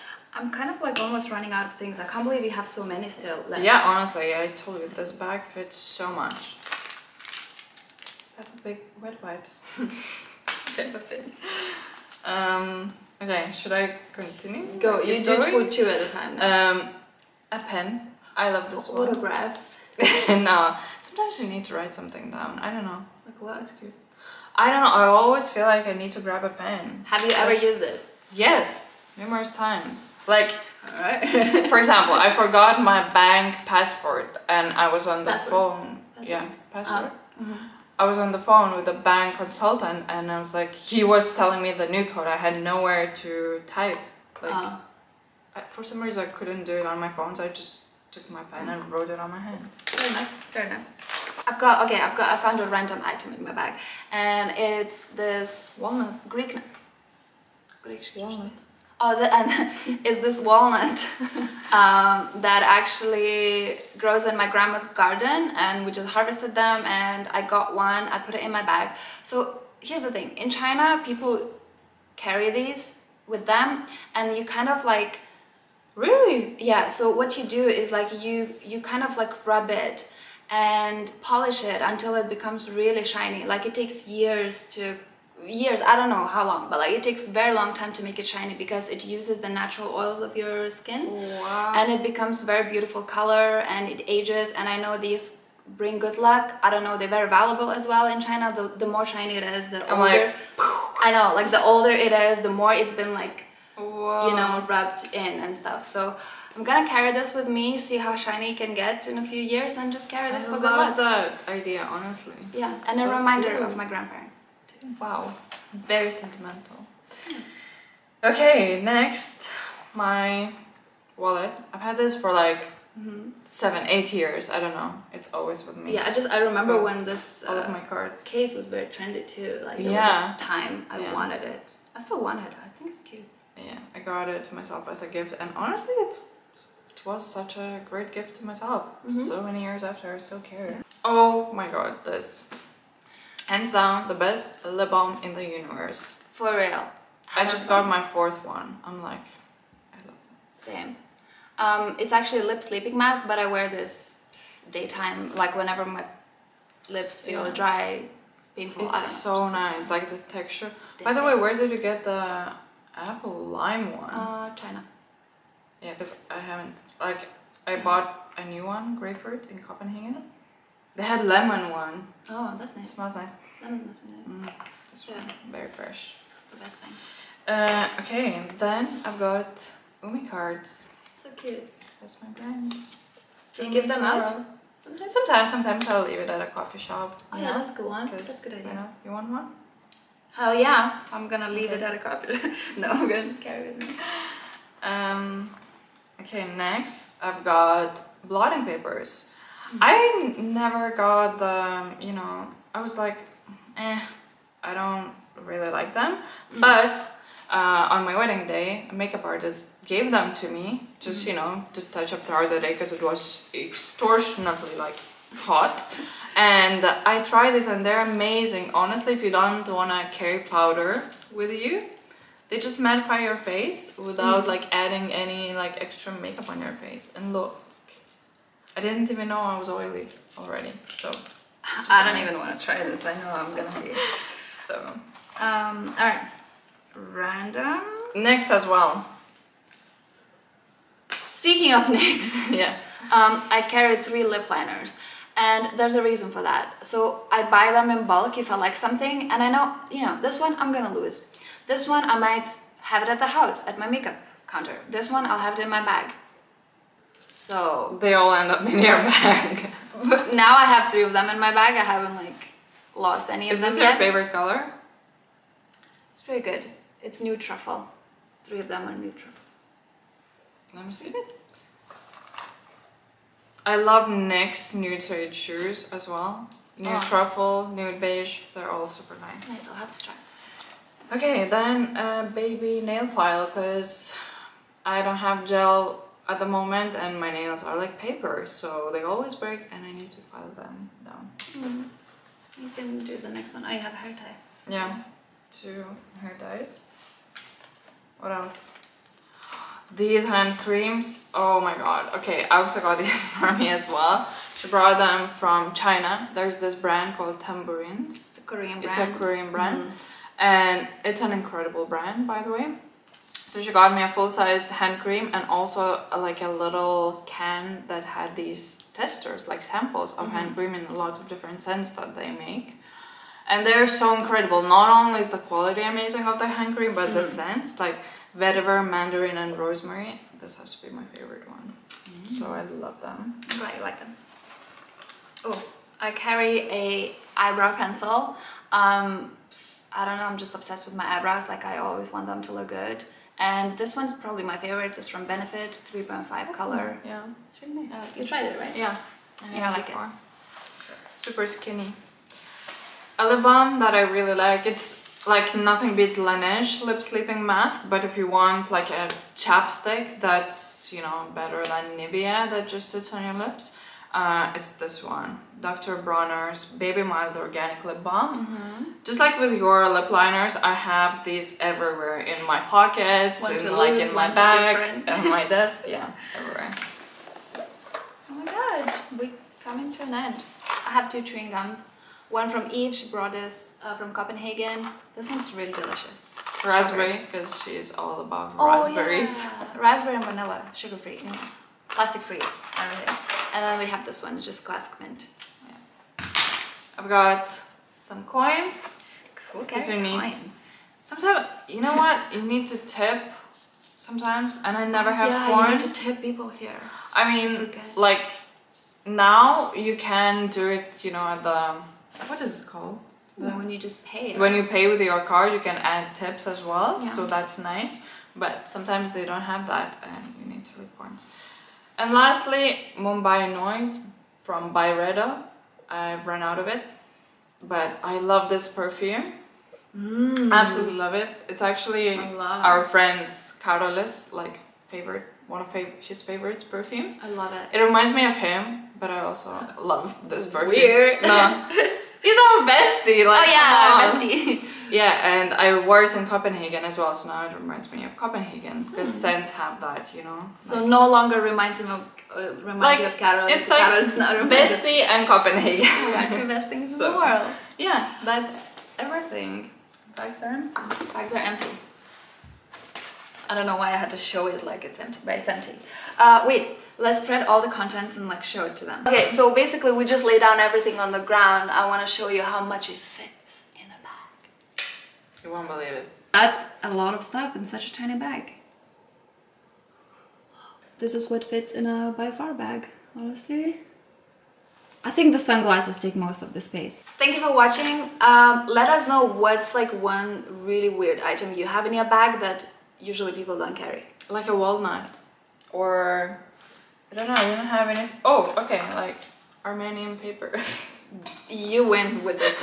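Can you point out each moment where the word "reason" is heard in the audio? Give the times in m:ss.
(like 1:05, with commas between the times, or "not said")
0:46, 4:06.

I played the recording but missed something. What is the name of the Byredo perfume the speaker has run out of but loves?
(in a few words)
Mumbai Noise.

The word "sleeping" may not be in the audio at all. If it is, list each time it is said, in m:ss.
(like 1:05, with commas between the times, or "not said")
2:32, 5:57.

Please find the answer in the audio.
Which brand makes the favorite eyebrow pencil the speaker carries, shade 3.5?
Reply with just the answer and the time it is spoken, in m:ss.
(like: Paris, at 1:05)
Benefit, at 5:45.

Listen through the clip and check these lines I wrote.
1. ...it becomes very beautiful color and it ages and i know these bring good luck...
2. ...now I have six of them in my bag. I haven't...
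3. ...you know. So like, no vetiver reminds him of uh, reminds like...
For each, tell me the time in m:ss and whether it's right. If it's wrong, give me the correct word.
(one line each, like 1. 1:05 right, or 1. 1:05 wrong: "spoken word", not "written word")
1. 1:31 right
2. 4:20 wrong: "three", not "six"
3. 7:30 wrong: "longer", not "vetiver".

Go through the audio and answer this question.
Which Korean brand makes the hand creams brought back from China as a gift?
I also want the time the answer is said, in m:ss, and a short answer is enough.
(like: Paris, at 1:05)
Tamburins, at 5:07.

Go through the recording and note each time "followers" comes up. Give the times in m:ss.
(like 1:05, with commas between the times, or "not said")
not said.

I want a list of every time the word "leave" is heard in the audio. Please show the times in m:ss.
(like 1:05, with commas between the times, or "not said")
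3:06, 3:11.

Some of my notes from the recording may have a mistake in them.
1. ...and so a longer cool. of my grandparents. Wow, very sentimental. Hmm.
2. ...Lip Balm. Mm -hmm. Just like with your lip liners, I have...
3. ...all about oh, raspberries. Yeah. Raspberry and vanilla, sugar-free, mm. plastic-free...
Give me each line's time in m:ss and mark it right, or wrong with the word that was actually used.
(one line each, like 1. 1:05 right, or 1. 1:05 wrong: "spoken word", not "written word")
1. 1:52 wrong: "reminder", not "longer"
2. 6:07 right
3. 6:28 right.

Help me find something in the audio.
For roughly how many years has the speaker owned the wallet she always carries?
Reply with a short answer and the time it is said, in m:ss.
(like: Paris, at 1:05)
Seven, eight years, at 2:03.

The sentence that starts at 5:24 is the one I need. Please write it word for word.
Not only is the quality amazing of the hand cream, but mm -hmm.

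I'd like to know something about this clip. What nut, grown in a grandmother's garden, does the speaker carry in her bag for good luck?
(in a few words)
Greek walnut.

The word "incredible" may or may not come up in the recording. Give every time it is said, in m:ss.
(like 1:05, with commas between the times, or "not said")
5:11, 5:24.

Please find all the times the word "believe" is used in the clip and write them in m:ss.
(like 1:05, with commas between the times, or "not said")
0:02, 7:55.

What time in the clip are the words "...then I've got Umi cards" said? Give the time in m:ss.
2:58.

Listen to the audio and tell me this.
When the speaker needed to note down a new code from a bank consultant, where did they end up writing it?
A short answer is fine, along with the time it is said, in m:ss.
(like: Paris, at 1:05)
On my hand, at 0:48.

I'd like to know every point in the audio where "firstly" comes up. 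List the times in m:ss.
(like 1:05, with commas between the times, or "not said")
not said.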